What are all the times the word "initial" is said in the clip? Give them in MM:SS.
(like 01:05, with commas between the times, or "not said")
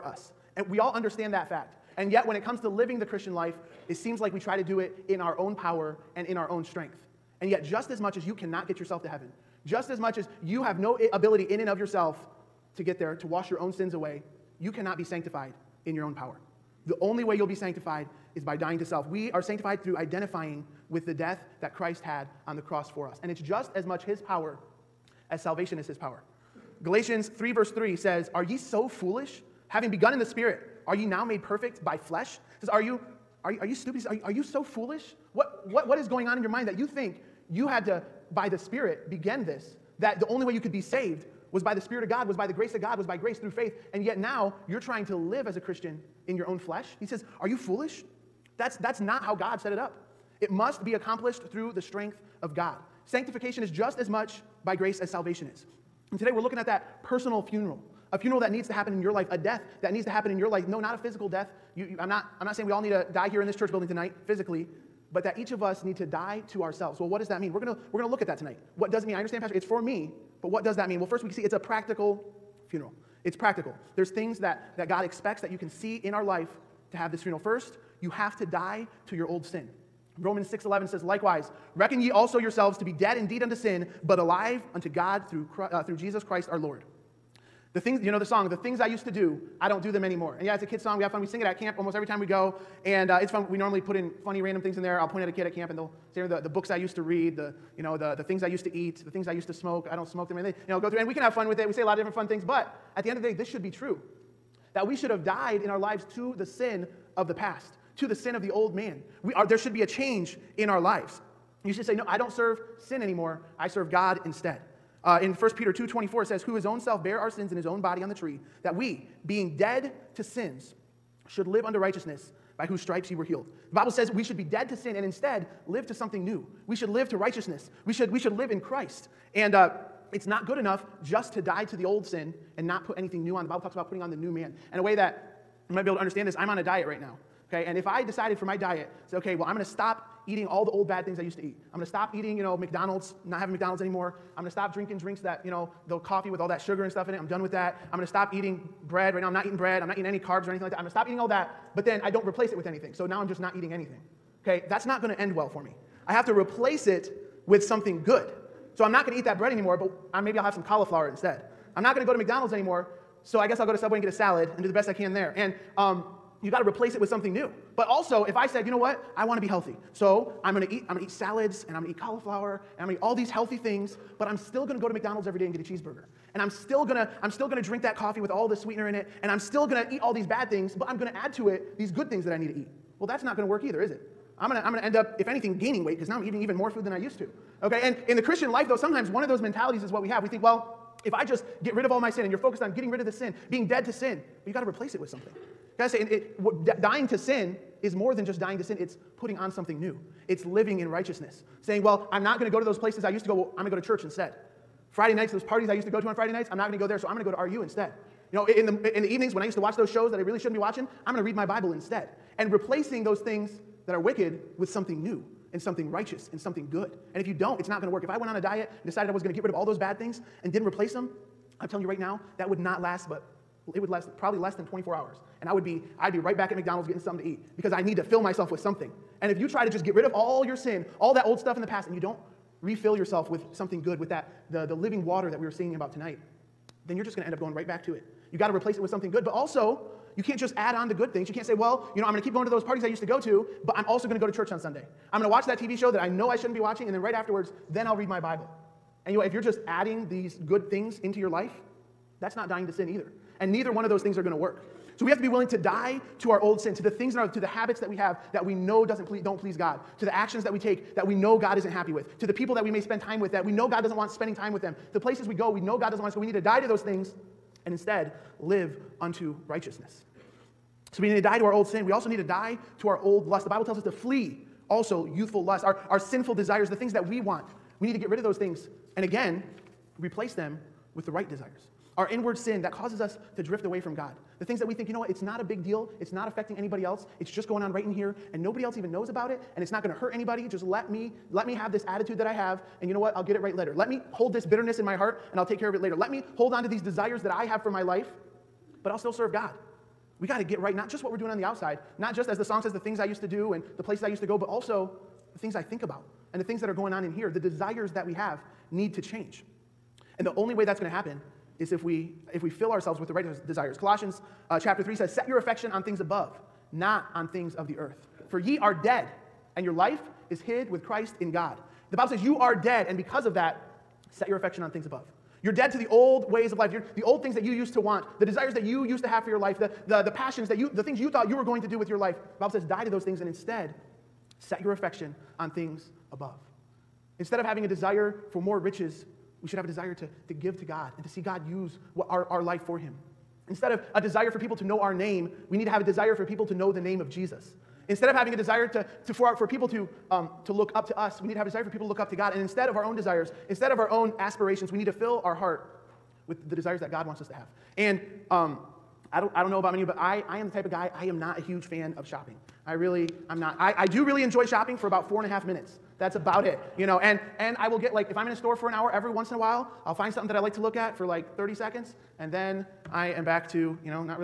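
not said.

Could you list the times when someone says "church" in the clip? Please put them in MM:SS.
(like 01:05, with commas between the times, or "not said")
01:03, 03:23, 04:04.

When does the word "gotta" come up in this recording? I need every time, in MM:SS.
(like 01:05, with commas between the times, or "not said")
03:15, 05:00.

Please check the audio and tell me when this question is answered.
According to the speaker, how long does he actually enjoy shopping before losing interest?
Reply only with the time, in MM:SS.
06:05.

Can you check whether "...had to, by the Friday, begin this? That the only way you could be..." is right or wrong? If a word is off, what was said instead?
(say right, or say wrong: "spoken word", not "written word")
wrong: "Spirit", not "Friday".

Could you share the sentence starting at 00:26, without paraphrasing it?
Galatians 3, verse 3 says, Are ye so foolish?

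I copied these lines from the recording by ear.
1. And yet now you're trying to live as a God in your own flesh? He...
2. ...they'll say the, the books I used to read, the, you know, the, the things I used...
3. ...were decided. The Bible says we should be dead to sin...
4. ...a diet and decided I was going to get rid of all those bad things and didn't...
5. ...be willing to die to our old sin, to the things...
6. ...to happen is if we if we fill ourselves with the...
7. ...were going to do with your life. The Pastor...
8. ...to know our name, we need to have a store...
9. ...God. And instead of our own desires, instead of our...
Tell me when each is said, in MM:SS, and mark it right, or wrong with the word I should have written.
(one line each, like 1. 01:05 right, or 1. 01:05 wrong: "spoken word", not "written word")
1. 00:43 wrong: "Christian", not "God"
2. 01:35 right
3. 02:03 wrong: "healed", not "decided"
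4. 03:38 right
5. 04:15 right
6. 05:10 right
7. 05:31 wrong: "Bible", not "Pastor"
8. 05:44 wrong: "desire", not "store"
9. 05:52 right.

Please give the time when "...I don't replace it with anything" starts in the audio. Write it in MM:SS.
02:32.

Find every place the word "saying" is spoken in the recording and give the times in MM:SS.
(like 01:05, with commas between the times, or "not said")
01:02, 03:21.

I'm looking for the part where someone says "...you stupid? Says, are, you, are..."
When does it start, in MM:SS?
00:33.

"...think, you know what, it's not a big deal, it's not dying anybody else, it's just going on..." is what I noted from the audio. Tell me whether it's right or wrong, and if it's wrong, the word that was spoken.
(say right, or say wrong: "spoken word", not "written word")
wrong: "affecting", not "dying".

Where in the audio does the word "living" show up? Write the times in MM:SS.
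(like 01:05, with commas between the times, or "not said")
00:02, 03:20, 03:54.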